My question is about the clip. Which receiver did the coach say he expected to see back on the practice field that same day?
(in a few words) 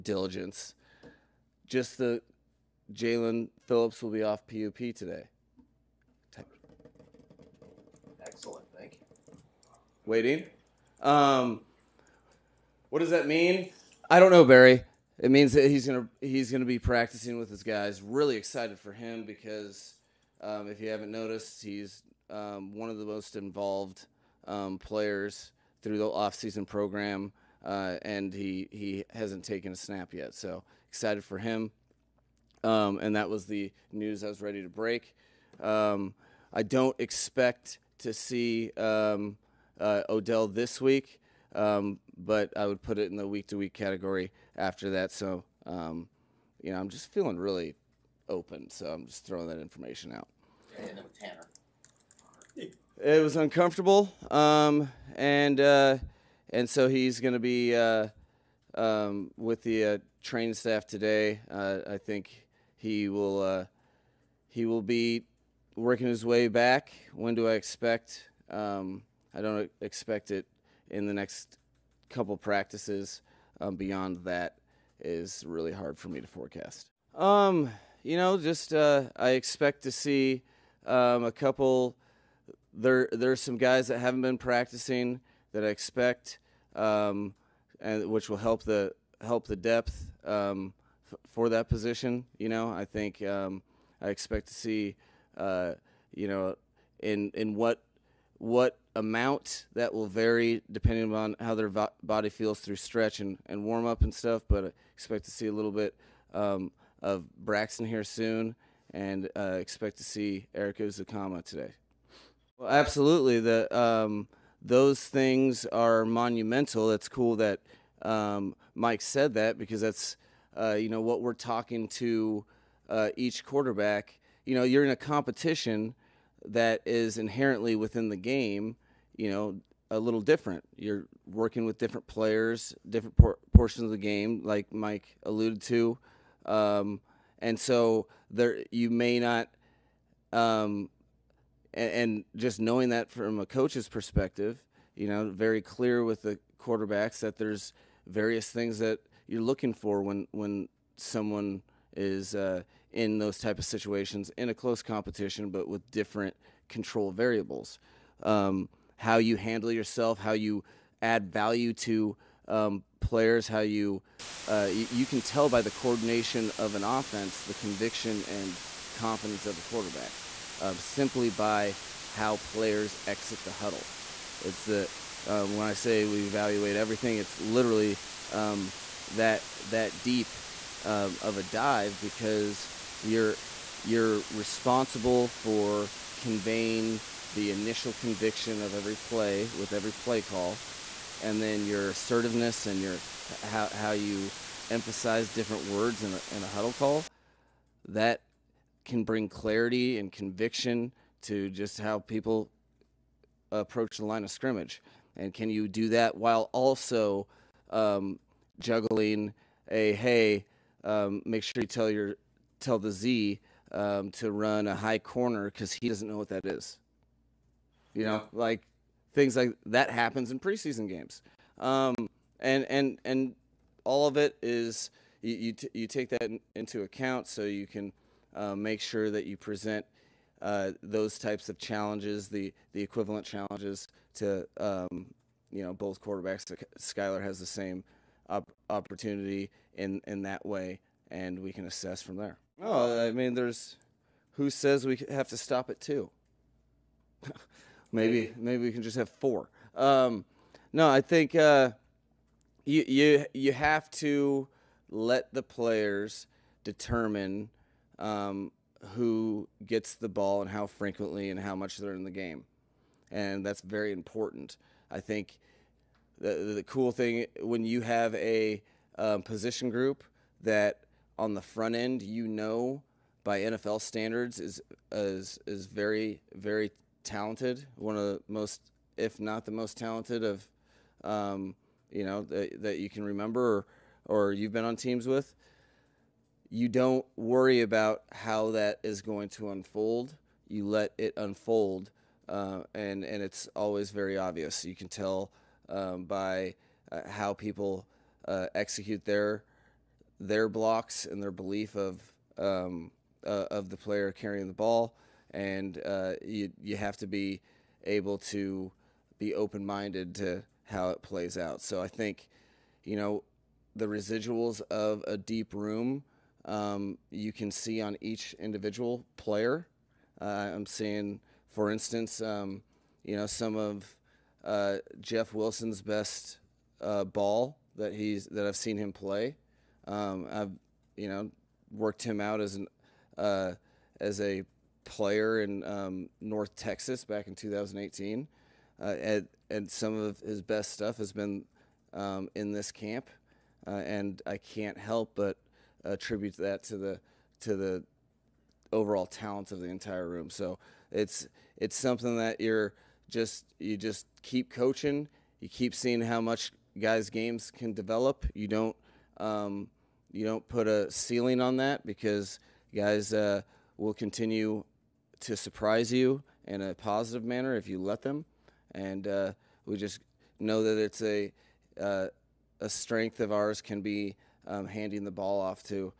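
Erik Ezukanma.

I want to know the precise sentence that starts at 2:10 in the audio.
You're working with different players, different por- portions of the game, like Mike alluded to, um, and so there you may not.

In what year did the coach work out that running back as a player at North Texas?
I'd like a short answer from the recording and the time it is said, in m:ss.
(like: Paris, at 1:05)
2018, at 5:37.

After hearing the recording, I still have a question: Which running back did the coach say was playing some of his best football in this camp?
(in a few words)
Jeff Wilson.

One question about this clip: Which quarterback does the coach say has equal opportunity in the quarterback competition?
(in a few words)
Skylar.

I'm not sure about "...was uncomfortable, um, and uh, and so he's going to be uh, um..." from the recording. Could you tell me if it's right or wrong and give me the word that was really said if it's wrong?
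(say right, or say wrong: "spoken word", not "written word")
right.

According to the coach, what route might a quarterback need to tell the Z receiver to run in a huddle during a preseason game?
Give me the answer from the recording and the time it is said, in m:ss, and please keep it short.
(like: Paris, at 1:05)
High corner, at 3:34.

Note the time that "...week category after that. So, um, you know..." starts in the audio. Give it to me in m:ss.
0:43.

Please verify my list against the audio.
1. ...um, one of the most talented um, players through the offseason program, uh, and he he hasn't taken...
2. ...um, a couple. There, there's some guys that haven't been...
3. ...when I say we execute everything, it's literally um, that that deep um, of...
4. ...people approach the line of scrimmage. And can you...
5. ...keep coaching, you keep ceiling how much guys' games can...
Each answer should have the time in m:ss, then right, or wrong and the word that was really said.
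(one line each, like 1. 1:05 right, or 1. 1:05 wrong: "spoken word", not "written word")
1. 0:22 wrong: "involved", not "talented"
2. 1:20 right
3. 2:55 wrong: "evaluate", not "execute"
4. 3:21 right
5. 5:54 wrong: "seeing", not "ceiling".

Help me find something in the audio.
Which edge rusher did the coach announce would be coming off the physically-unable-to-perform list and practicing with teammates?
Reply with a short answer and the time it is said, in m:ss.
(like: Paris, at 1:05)
Jaelan Phillips, at 0:02.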